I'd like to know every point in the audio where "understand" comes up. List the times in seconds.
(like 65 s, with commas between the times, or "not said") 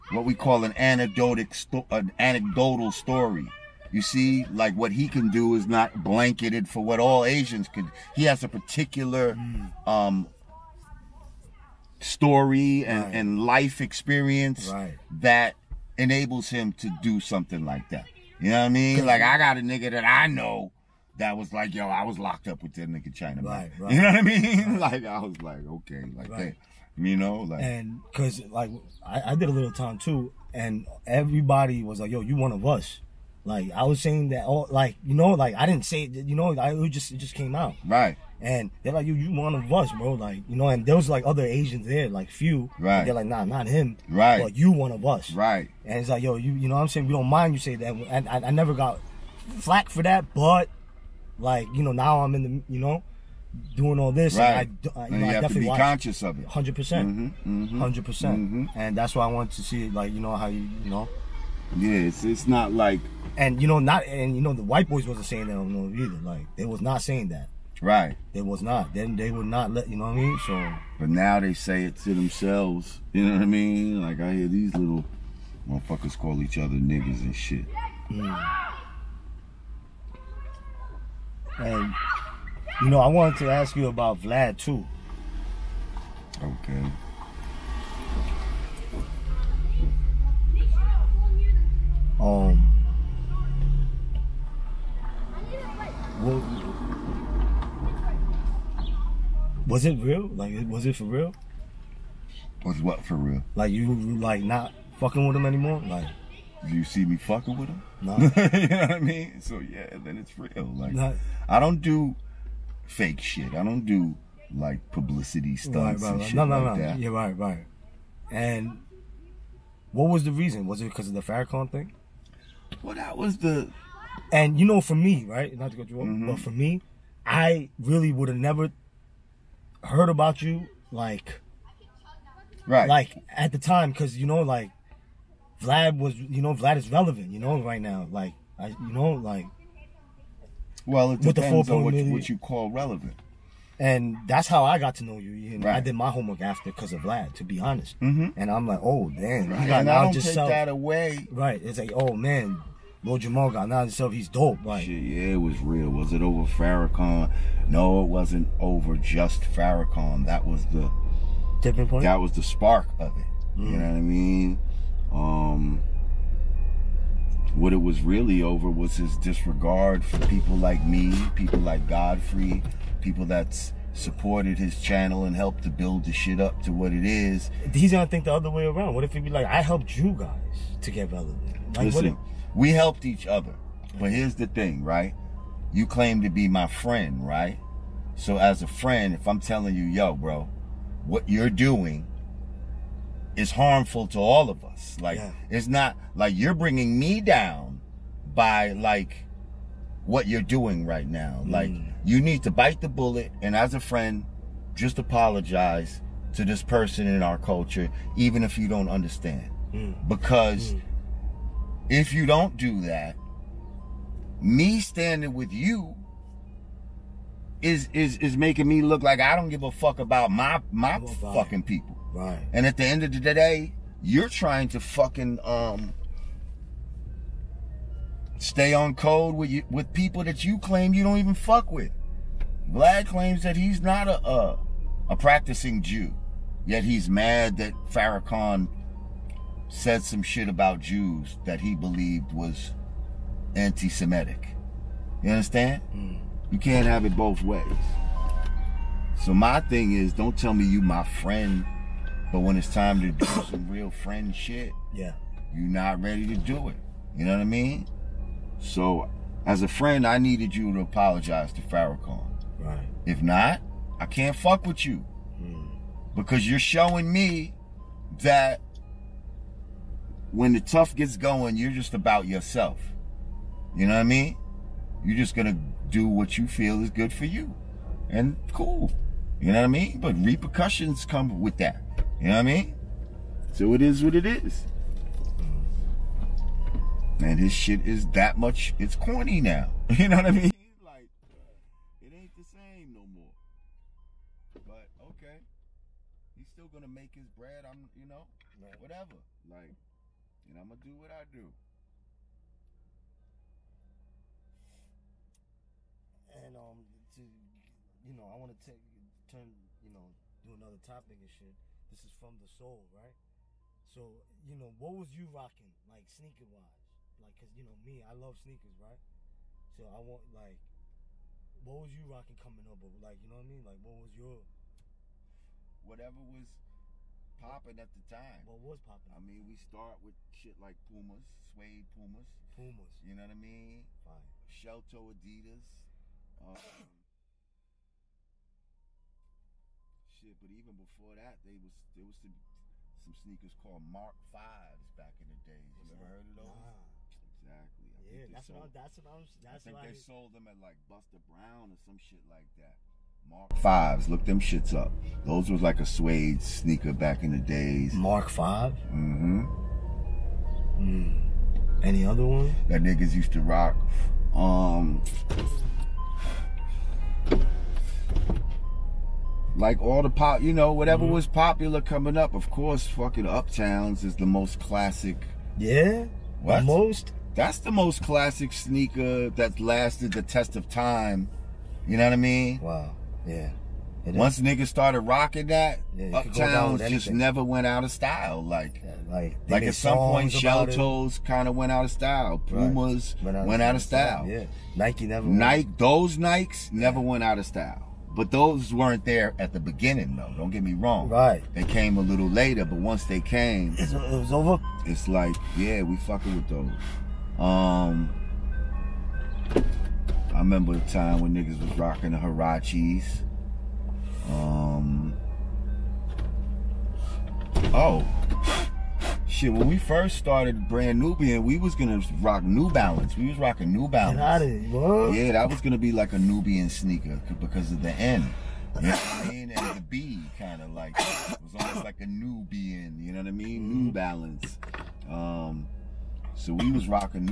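208 s, 245 s.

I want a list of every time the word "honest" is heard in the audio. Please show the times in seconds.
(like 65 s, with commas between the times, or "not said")
147 s.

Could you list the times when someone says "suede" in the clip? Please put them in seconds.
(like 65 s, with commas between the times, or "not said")
331 s, 355 s.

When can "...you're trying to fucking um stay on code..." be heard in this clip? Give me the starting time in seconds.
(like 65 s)
224 s.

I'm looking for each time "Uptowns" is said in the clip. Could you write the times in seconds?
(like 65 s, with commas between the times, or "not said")
373 s, 386 s.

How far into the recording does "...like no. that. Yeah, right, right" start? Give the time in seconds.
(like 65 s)
116 s.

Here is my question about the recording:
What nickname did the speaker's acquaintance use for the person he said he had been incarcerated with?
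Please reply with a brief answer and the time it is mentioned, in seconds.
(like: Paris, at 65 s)
China, at 23 s.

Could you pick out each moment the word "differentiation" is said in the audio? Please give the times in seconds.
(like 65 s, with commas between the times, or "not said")
not said.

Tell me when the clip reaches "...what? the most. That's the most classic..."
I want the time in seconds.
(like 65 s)
376 s.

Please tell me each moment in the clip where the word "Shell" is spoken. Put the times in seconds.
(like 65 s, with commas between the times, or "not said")
334 s, 390 s.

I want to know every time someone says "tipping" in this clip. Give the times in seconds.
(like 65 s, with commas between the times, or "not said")
161 s.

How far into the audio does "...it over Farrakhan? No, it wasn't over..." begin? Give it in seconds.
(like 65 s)
156 s.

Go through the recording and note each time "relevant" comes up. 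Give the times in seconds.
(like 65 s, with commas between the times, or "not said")
136 s, 142 s, 181 s.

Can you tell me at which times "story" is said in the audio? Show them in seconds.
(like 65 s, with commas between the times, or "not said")
2 s, 11 s.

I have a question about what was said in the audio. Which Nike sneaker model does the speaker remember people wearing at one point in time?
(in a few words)
Huaraches.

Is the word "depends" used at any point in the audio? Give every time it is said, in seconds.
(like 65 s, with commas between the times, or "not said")
141 s.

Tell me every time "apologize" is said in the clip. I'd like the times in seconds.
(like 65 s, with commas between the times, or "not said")
204 s, 260 s.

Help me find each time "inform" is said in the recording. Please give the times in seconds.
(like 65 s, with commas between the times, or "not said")
not said.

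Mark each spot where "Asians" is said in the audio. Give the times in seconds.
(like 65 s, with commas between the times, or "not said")
7 s, 41 s.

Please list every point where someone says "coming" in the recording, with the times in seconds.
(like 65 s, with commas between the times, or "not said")
322 s, 371 s.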